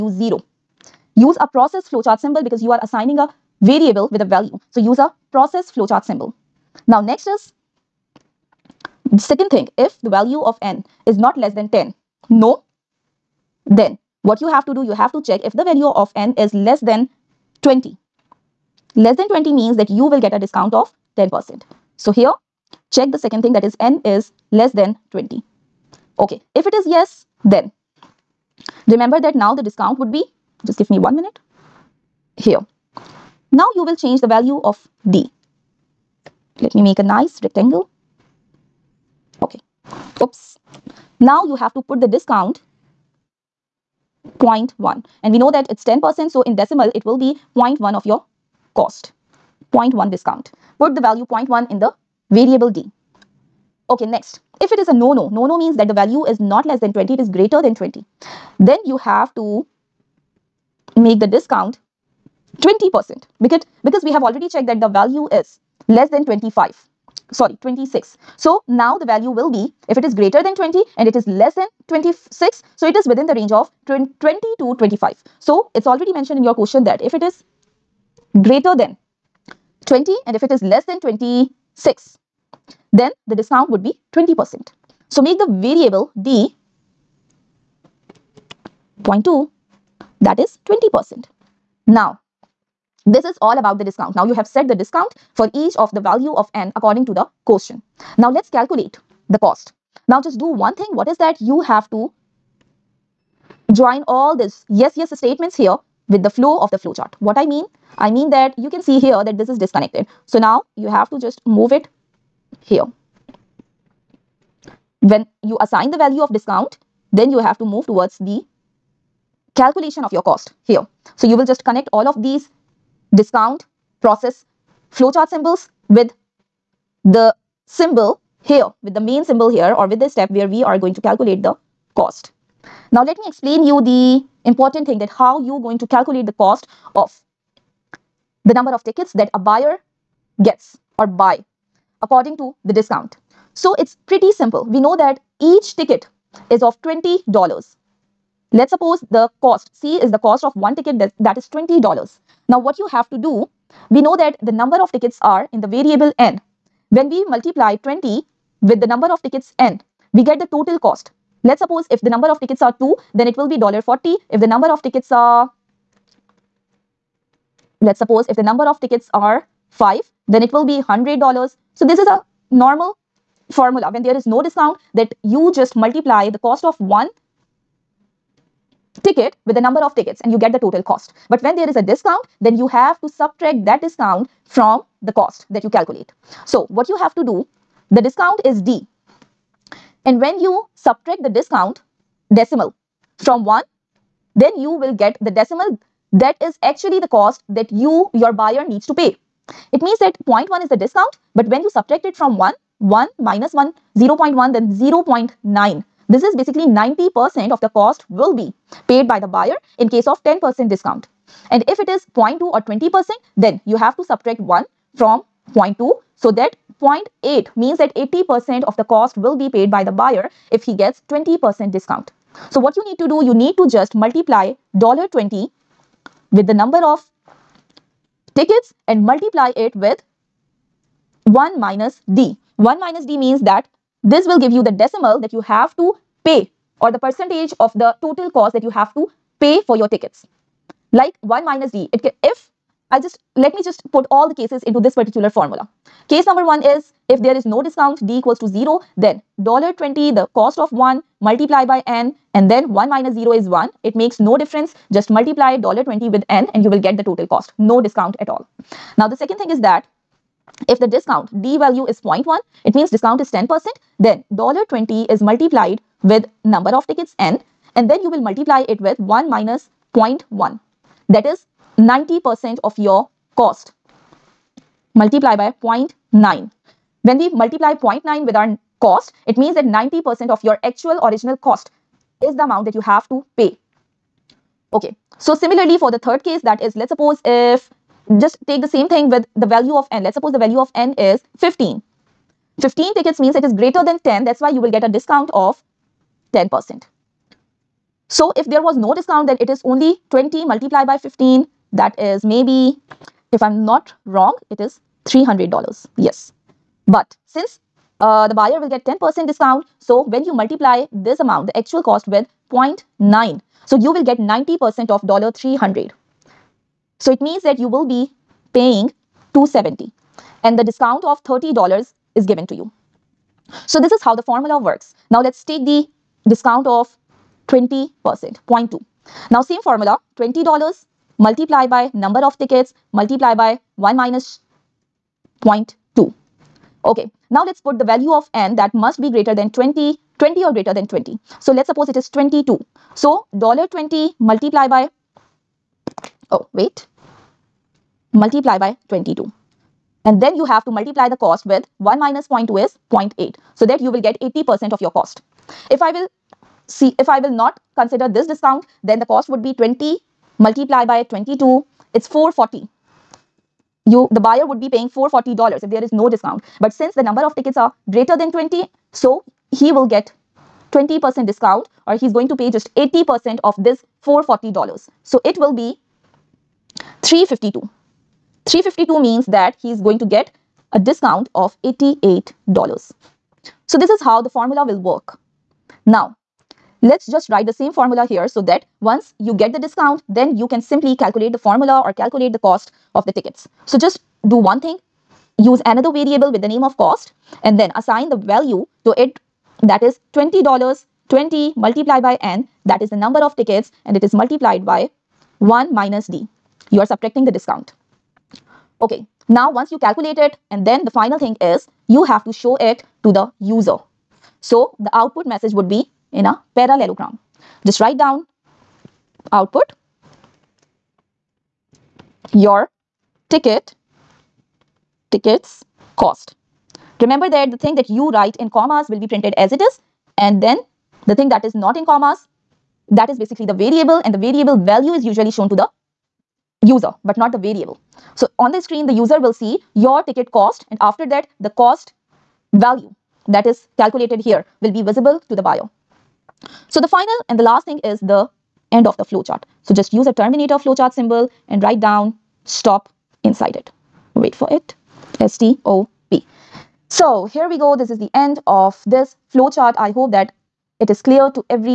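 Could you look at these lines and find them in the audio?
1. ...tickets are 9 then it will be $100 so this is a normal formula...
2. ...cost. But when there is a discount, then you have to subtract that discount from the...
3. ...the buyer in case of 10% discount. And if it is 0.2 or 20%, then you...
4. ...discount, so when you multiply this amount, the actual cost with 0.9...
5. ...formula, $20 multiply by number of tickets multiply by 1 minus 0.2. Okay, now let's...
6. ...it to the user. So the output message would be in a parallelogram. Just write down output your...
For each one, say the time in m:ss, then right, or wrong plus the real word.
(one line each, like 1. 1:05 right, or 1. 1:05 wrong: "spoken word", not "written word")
1. 2:48 wrong: "5", not "9"
2. 3:00 right
3. 3:29 right
4. 5:09 right
5. 5:29 right
6. 6:52 right.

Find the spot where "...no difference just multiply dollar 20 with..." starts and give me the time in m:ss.
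4:14.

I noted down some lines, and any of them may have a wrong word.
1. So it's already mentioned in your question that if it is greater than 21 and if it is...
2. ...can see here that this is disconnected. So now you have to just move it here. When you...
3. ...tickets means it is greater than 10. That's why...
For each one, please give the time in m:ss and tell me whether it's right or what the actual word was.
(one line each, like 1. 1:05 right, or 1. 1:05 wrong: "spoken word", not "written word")
1. 1:15 wrong: "20", not "21"
2. 1:48 right
3. 4:52 right.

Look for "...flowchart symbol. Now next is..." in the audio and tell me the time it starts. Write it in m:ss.
0:05.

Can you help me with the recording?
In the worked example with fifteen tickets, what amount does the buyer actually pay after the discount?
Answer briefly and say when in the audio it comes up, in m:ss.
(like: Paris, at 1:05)
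$270, at 5:19.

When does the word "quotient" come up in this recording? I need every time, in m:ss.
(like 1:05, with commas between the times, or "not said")
1:37.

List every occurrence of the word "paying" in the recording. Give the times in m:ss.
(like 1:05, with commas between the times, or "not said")
5:18, 6:04.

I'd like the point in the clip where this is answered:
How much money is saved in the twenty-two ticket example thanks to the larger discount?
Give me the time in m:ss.
6:21.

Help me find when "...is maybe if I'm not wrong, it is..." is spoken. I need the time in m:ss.
5:01.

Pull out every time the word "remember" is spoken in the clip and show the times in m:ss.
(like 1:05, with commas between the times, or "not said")
0:28, 7:07.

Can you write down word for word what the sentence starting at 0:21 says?
So here, check the second thing that is n is less than 20.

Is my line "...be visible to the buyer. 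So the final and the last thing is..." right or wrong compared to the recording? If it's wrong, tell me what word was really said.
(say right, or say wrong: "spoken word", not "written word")
right.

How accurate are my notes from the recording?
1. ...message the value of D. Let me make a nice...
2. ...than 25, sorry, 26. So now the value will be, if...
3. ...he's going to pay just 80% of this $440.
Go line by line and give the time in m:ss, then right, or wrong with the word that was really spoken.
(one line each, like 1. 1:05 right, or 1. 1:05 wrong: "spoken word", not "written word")
1. 0:33 wrong: "change", not "message"
2. 1:06 right
3. 6:12 right.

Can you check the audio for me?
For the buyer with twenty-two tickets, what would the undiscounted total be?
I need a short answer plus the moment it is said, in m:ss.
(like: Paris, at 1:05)
$440, at 6:01.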